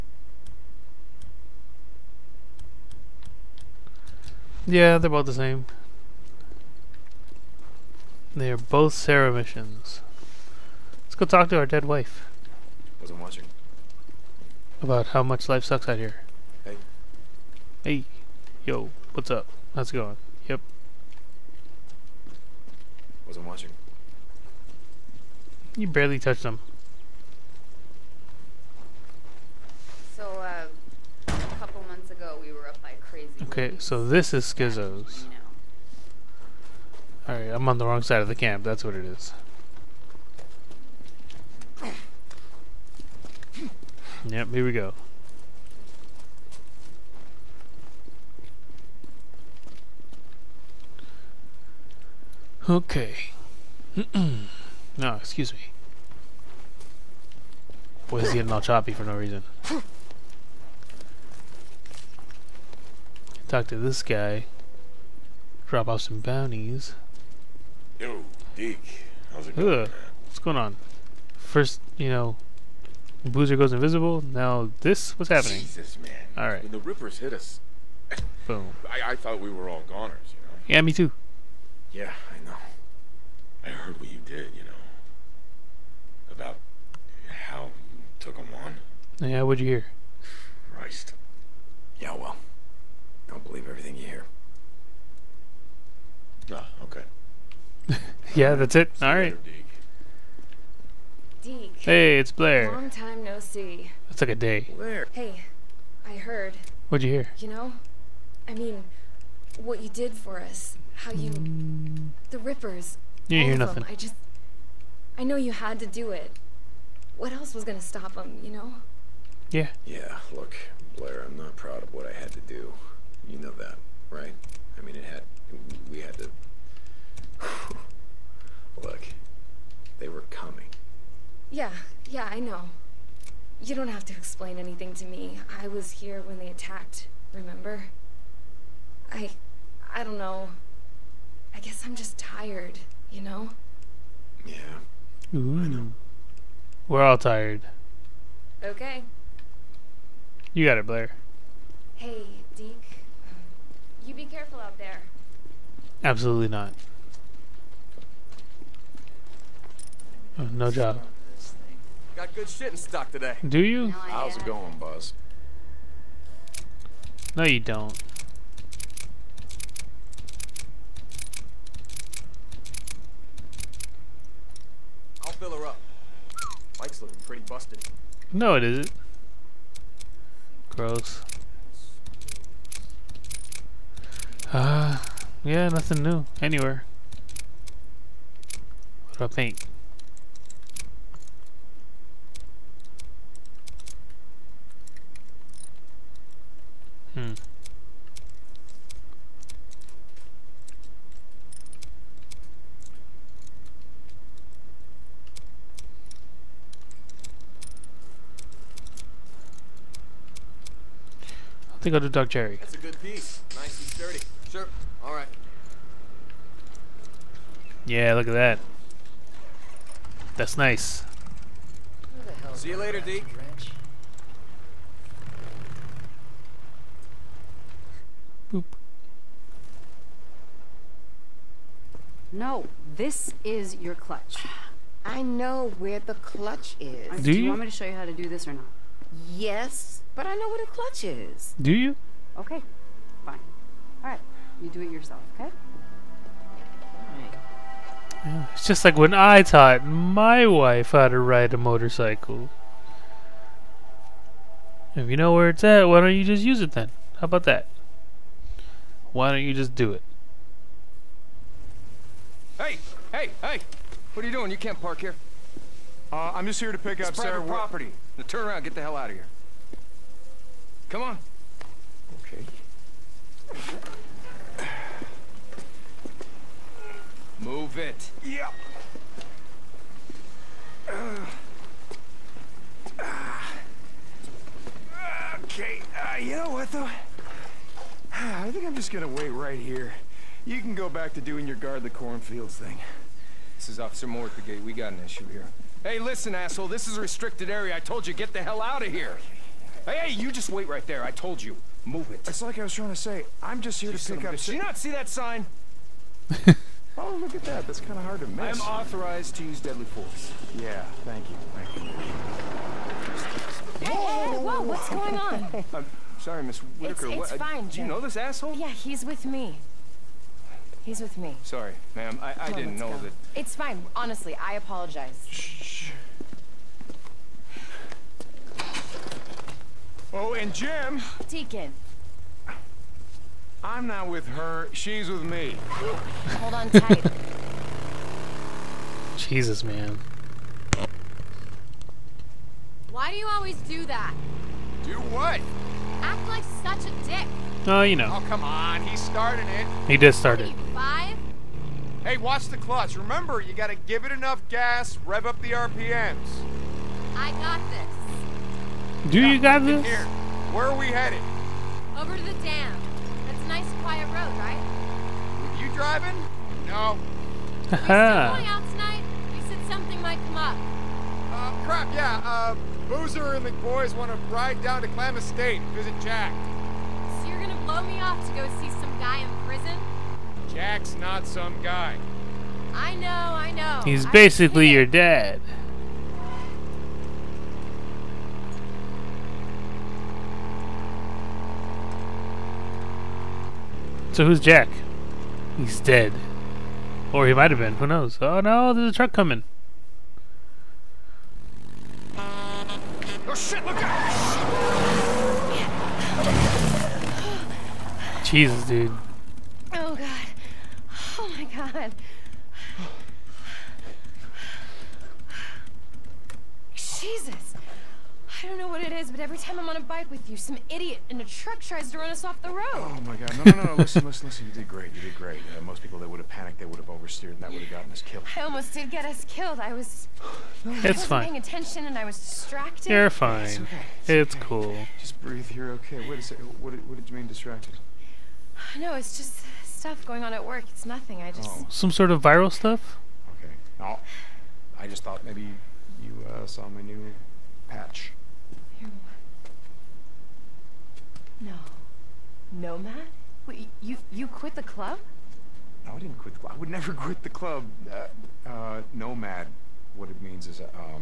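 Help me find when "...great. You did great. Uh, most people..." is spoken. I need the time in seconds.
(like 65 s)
424 s.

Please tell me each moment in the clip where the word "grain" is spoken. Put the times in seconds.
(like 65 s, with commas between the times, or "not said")
not said.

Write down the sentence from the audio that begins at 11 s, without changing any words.
Let's go talk to our dead wife.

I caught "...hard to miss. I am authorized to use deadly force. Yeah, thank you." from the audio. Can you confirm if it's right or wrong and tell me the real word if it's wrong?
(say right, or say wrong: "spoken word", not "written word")
right.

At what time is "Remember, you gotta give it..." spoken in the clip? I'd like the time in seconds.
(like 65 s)
352 s.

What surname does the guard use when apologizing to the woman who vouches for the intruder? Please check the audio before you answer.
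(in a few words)
Whitaker.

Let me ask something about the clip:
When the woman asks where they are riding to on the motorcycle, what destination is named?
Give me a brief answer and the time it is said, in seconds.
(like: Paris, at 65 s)
The dam, at 362 s.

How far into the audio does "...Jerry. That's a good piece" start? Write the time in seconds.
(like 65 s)
212 s.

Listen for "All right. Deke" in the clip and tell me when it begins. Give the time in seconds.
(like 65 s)
99 s.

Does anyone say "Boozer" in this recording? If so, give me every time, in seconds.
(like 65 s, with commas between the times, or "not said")
73 s, 372 s.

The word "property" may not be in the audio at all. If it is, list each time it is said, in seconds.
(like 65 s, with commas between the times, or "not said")
267 s.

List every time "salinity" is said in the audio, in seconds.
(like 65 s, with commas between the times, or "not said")
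not said.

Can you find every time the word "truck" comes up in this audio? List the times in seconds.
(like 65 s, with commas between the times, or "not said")
398 s, 421 s.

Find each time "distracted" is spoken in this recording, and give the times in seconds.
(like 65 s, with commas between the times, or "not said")
432 s, 437 s.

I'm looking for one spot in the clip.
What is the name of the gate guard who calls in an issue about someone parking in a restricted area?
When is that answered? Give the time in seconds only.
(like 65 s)
293 s.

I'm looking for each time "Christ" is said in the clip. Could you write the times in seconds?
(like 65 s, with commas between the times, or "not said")
90 s.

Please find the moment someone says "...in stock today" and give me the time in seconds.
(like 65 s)
162 s.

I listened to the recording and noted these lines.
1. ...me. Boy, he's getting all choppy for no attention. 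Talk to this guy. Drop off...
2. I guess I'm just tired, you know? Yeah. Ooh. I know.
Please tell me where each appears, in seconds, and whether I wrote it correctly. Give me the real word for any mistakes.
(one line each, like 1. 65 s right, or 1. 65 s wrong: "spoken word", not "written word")
1. 55 s wrong: "reason", not "attention"
2. 141 s right.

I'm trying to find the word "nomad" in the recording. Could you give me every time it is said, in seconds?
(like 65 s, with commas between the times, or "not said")
452 s, 458 s.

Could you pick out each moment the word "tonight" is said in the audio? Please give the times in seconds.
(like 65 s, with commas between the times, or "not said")
368 s.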